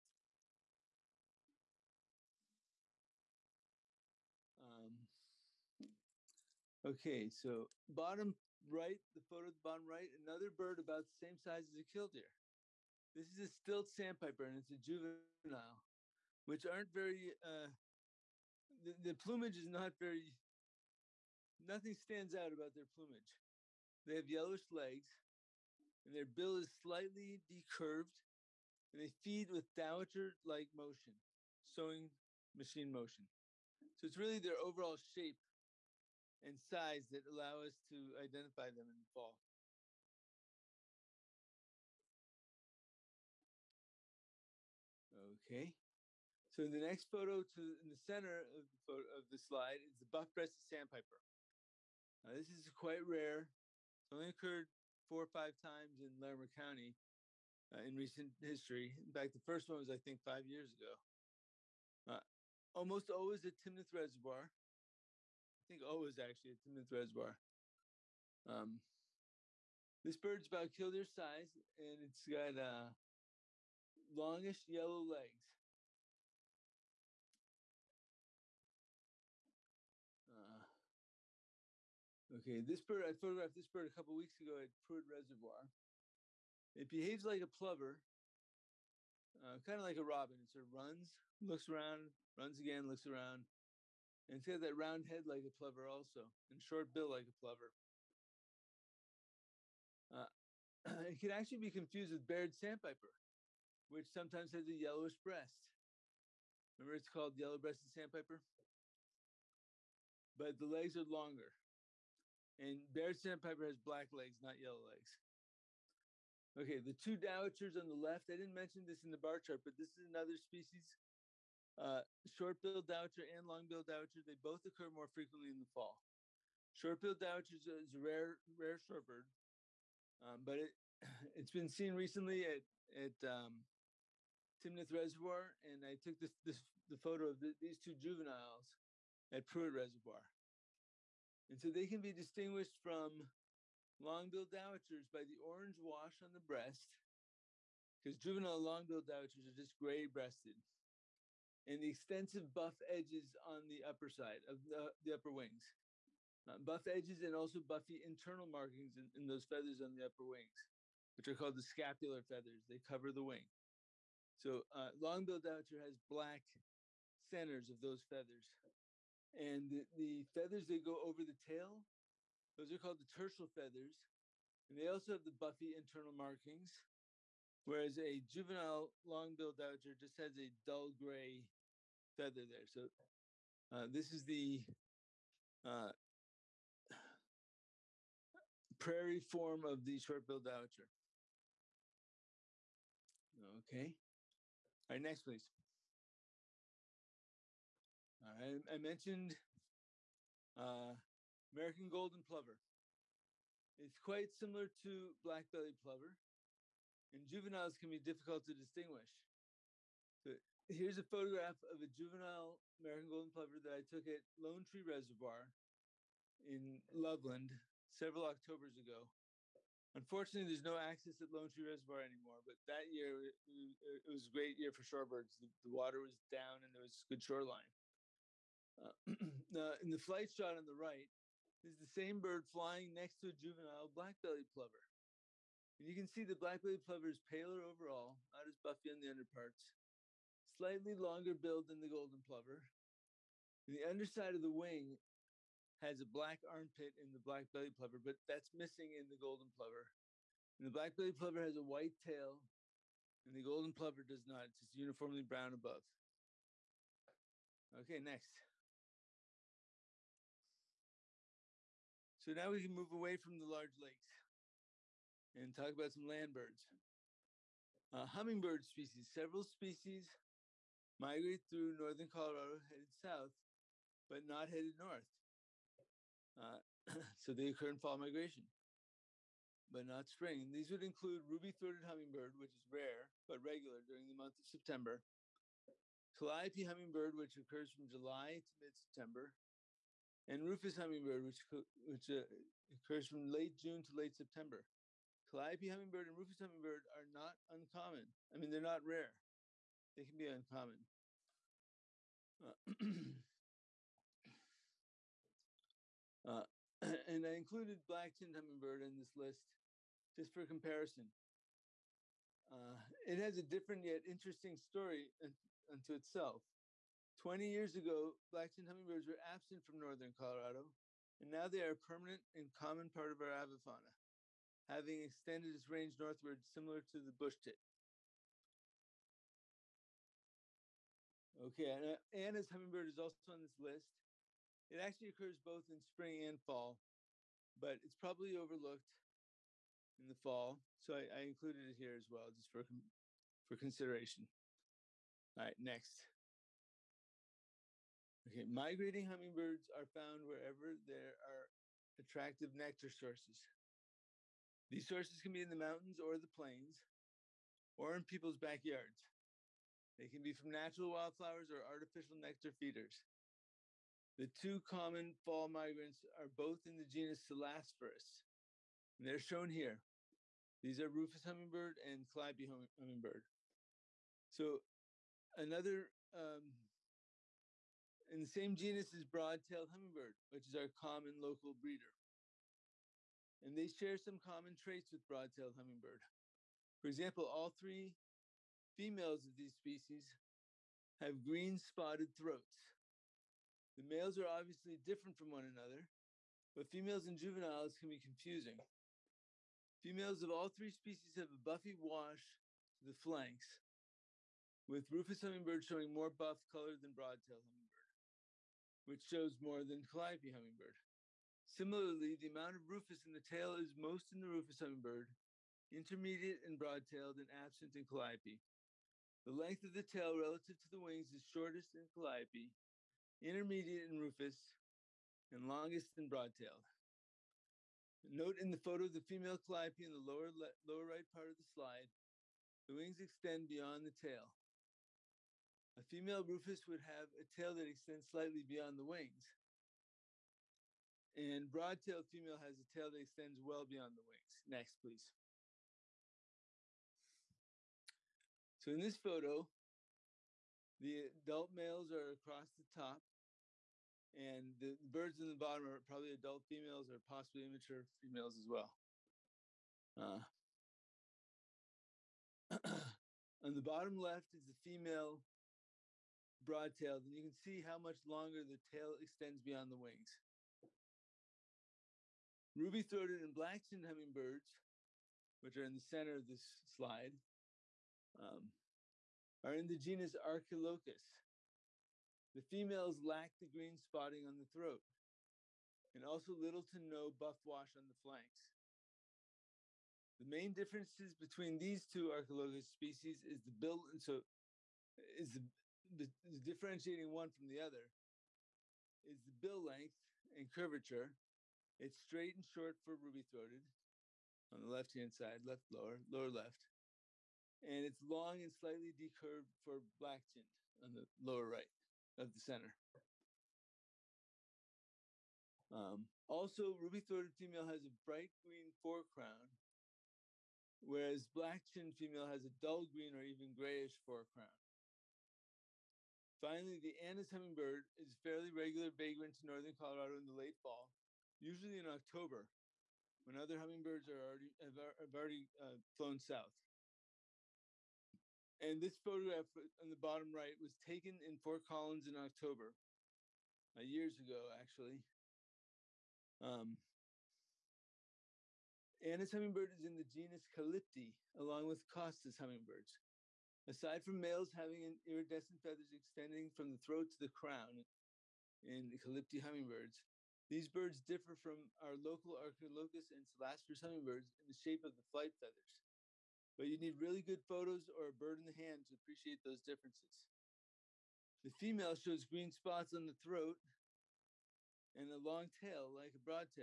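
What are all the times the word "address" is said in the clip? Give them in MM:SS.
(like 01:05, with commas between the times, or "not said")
not said.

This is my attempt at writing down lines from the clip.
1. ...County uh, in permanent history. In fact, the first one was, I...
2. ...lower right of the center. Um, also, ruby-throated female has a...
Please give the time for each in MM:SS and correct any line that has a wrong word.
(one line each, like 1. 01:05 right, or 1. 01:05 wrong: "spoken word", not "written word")
1. 00:56 wrong: "recent", not "permanent"
2. 08:31 right.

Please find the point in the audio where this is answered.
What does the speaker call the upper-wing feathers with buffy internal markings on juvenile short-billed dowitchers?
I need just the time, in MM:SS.
02:41.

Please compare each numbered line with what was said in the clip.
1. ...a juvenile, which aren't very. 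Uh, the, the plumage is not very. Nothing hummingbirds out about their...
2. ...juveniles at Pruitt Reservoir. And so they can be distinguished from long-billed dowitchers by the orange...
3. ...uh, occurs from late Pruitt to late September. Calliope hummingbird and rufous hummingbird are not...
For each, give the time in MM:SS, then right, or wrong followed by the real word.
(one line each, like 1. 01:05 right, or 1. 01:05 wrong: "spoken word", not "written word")
1. 00:14 wrong: "stands", not "hummingbirds"
2. 02:17 right
3. 04:52 wrong: "June", not "Pruitt".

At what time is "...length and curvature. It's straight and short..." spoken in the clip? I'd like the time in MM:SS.
08:19.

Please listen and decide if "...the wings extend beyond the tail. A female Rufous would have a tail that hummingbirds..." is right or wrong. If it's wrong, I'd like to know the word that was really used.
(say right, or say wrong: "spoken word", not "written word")
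wrong: "extends", not "hummingbirds".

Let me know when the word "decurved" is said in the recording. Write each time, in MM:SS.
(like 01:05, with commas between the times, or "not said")
00:27, 08:28.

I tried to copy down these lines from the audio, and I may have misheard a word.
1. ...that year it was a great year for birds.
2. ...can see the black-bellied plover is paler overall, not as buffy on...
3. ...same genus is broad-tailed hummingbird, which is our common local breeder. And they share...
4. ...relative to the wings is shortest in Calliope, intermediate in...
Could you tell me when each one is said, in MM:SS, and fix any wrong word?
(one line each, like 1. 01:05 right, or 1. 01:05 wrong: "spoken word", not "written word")
1. 03:42 wrong: "shorebirds", not "birds"
2. 03:55 right
3. 06:18 right
4. 07:00 right.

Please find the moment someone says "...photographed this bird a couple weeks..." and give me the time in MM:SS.
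01:23.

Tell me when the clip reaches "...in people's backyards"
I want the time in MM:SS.
05:57.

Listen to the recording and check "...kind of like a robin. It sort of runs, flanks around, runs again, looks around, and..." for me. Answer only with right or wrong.
wrong.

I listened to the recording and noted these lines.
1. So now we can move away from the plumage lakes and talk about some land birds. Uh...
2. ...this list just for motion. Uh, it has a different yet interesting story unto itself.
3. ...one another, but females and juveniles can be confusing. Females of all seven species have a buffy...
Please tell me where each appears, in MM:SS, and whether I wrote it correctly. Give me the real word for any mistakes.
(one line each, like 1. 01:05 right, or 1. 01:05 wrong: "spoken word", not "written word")
1. 04:22 wrong: "large", not "plumage"
2. 05:08 wrong: "comparison", not "motion"
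3. 06:35 wrong: "three", not "seven".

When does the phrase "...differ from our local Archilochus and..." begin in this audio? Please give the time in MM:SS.
09:21.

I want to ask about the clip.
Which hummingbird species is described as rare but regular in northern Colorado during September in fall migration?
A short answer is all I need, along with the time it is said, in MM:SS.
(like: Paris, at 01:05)
ruby-throated hummingbird, at 04:41.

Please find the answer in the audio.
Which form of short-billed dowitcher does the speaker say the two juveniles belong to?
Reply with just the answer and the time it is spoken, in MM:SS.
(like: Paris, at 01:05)
prairie form, at 03:08.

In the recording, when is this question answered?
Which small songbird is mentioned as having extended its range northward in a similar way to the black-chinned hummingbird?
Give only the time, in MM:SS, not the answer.
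05:27.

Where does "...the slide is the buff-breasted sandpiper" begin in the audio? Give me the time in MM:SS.
00:49.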